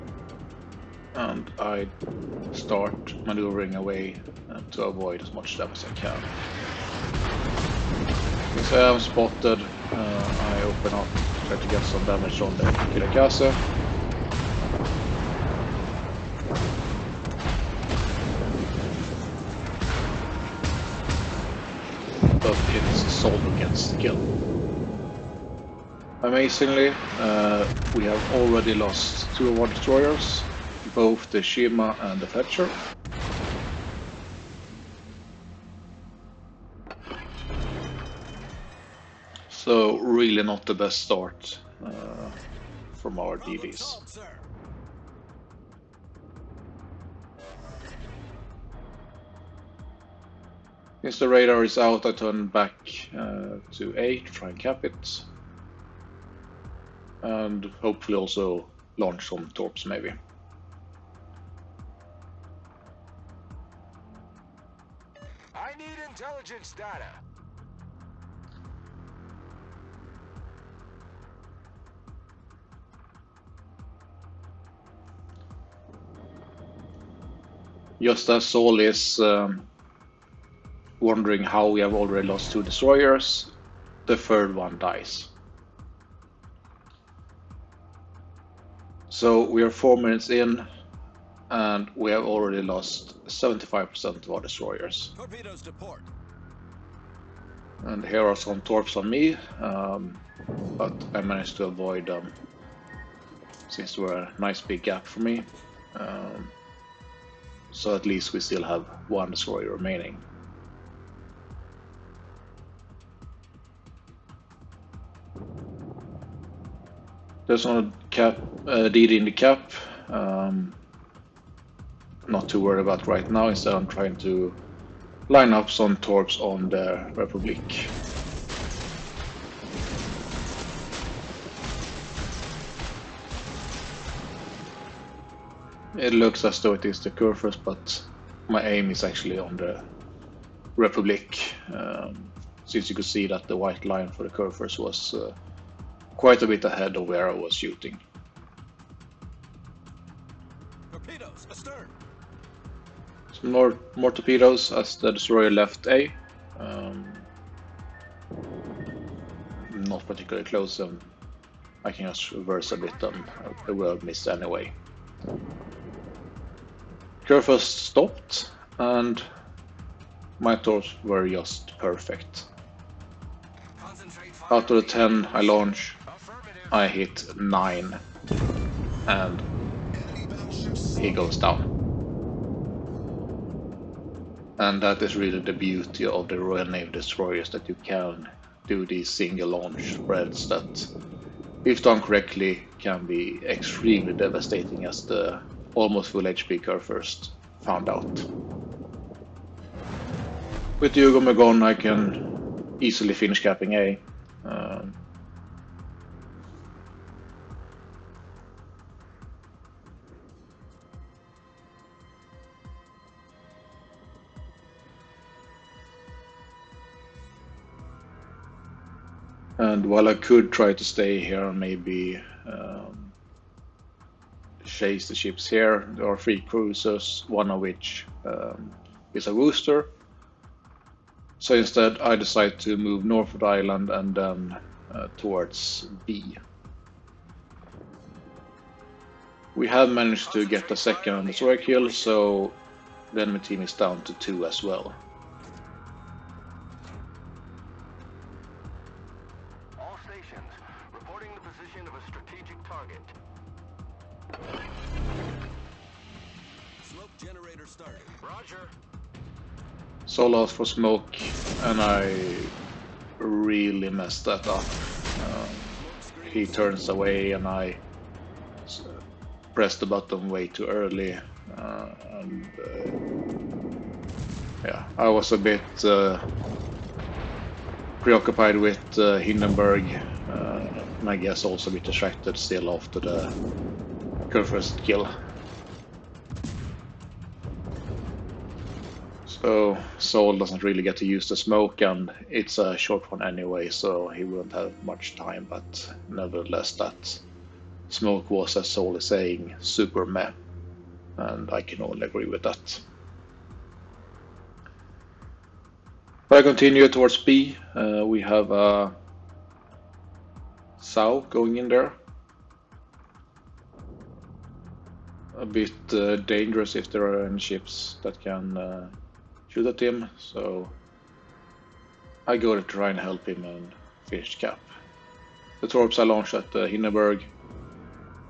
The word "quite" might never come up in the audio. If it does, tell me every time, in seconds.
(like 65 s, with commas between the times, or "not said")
146 s.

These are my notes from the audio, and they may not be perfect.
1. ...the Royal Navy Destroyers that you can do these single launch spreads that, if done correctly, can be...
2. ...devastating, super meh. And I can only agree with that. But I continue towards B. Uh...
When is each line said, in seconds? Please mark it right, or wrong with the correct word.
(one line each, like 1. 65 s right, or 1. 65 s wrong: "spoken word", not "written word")
1. 186 s right
2. 299 s wrong: "saying", not "devastating".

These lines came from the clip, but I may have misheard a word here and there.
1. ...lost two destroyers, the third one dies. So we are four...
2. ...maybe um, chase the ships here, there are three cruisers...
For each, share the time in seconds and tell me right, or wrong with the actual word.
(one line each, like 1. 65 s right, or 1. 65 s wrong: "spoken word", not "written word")
1. 82 s right
2. 221 s right.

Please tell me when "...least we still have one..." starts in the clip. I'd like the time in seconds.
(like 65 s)
108 s.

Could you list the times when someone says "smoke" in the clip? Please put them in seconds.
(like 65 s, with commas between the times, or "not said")
260 s, 291 s, 297 s.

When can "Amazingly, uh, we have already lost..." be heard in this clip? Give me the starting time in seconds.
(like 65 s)
26 s.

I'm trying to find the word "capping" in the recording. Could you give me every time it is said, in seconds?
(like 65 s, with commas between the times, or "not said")
203 s.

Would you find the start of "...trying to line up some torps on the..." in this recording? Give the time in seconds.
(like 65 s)
123 s.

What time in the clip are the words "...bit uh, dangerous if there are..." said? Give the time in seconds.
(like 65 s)
315 s.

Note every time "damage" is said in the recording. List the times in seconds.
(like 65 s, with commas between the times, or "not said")
5 s, 12 s.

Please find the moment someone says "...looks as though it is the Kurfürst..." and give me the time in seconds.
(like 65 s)
136 s.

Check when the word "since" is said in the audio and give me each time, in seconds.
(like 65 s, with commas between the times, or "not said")
8 s, 51 s, 103 s, 142 s.